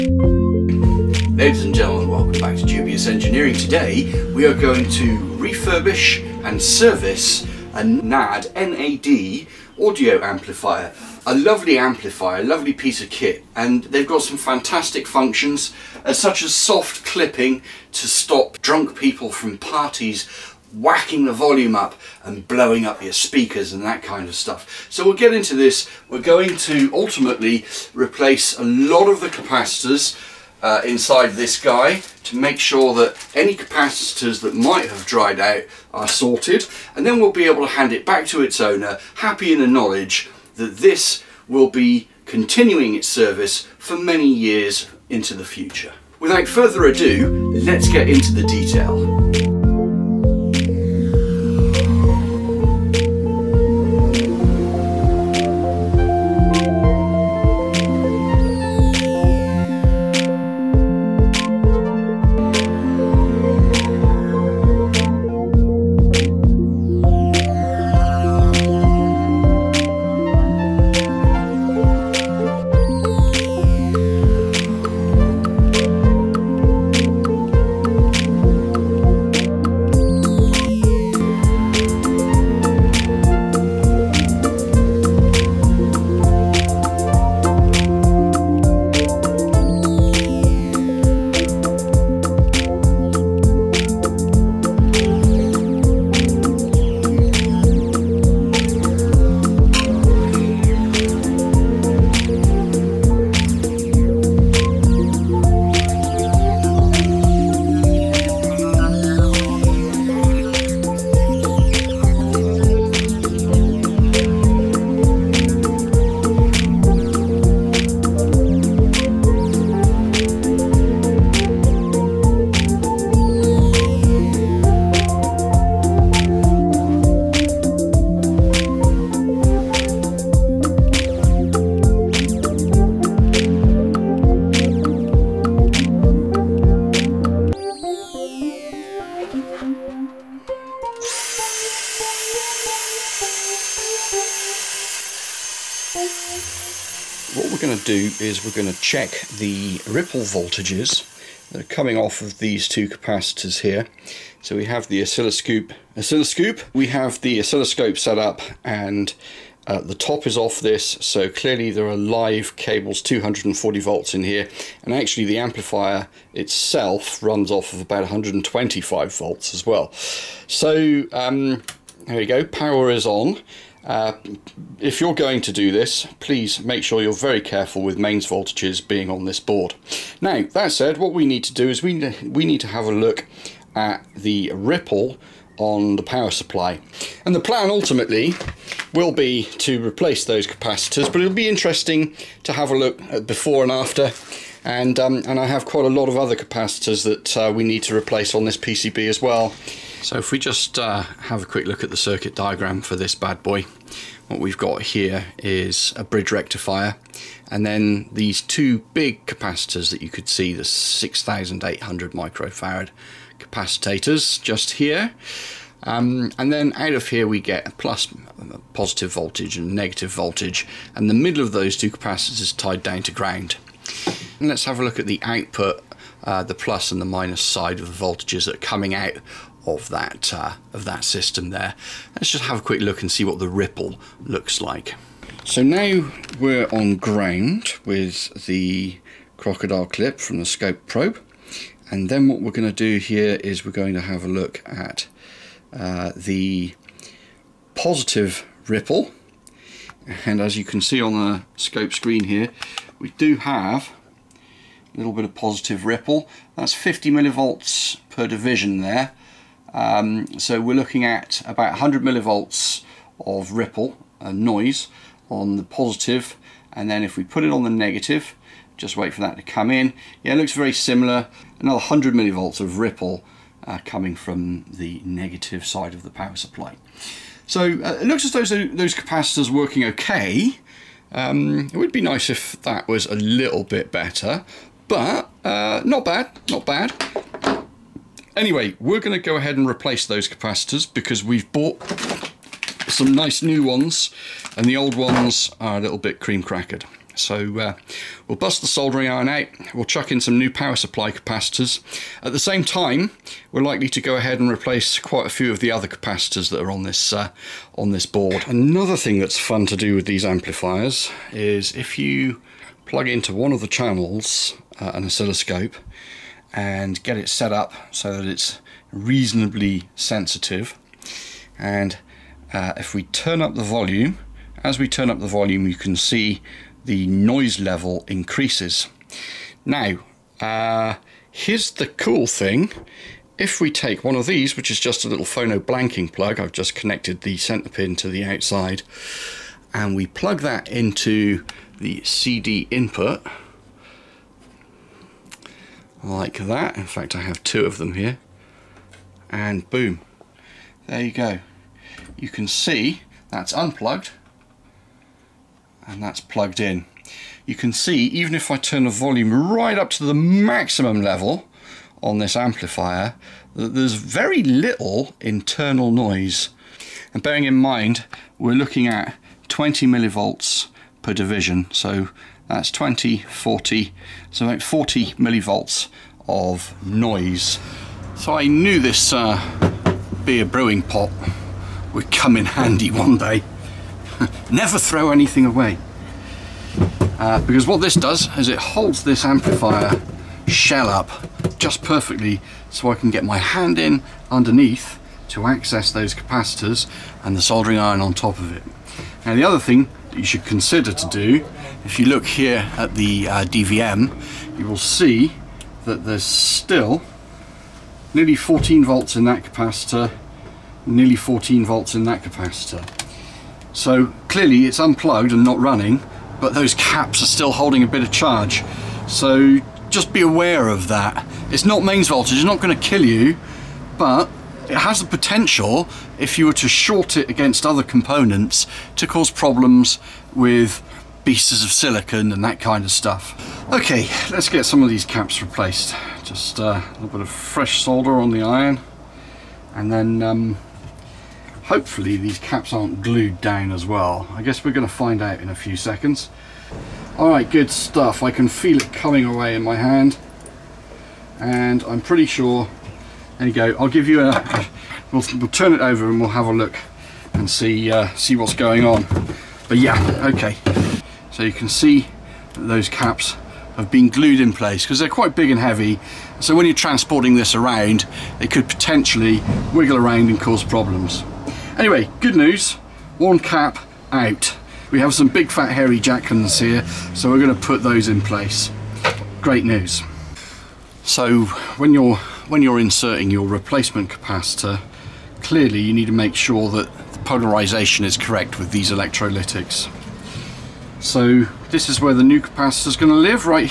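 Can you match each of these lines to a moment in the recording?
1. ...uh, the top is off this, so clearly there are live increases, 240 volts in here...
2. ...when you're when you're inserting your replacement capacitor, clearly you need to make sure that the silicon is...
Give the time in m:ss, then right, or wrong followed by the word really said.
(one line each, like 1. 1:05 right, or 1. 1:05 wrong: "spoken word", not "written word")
1. 2:39 wrong: "cables", not "increases"
2. 8:01 wrong: "polarization", not "silicon".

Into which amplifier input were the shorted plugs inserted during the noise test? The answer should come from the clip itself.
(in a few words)
CD input.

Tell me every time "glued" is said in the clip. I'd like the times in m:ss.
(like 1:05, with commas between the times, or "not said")
7:23, 7:44.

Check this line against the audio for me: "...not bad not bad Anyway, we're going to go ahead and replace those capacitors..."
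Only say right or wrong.
right.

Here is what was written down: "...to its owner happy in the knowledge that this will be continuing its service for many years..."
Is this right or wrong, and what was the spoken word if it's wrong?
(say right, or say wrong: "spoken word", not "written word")
right.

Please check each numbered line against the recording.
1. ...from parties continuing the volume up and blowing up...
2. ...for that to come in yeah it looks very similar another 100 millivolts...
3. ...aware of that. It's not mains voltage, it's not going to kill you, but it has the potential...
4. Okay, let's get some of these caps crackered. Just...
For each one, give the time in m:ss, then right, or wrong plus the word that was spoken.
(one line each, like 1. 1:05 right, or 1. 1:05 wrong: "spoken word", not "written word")
1. 0:19 wrong: "whacking", not "continuing"
2. 4:29 right
3. 7:00 right
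4. 7:13 wrong: "replaced", not "crackered".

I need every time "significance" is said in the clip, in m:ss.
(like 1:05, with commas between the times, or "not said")
not said.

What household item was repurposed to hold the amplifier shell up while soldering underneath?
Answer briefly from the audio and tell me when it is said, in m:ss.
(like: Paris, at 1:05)
beer brewing pot, at 6:20.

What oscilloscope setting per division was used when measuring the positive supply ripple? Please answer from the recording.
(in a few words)
50 millivolts.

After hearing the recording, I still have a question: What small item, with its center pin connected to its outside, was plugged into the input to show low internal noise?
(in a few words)
phono blanking plug.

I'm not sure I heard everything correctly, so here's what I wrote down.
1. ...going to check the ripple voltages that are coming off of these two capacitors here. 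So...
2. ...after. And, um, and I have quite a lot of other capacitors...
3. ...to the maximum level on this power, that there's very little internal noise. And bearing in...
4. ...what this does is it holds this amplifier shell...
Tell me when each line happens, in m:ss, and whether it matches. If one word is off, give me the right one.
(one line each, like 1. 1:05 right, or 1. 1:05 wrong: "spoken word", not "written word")
1. 2:28 right
2. 3:13 right
3. 5:59 wrong: "amplifier", not "power"
4. 6:27 right.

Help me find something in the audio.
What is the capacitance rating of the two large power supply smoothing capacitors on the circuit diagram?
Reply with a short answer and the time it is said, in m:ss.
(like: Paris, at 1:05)
6800 microfarad, at 3:30.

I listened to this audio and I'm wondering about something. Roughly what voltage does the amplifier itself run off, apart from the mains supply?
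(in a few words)
125 volts.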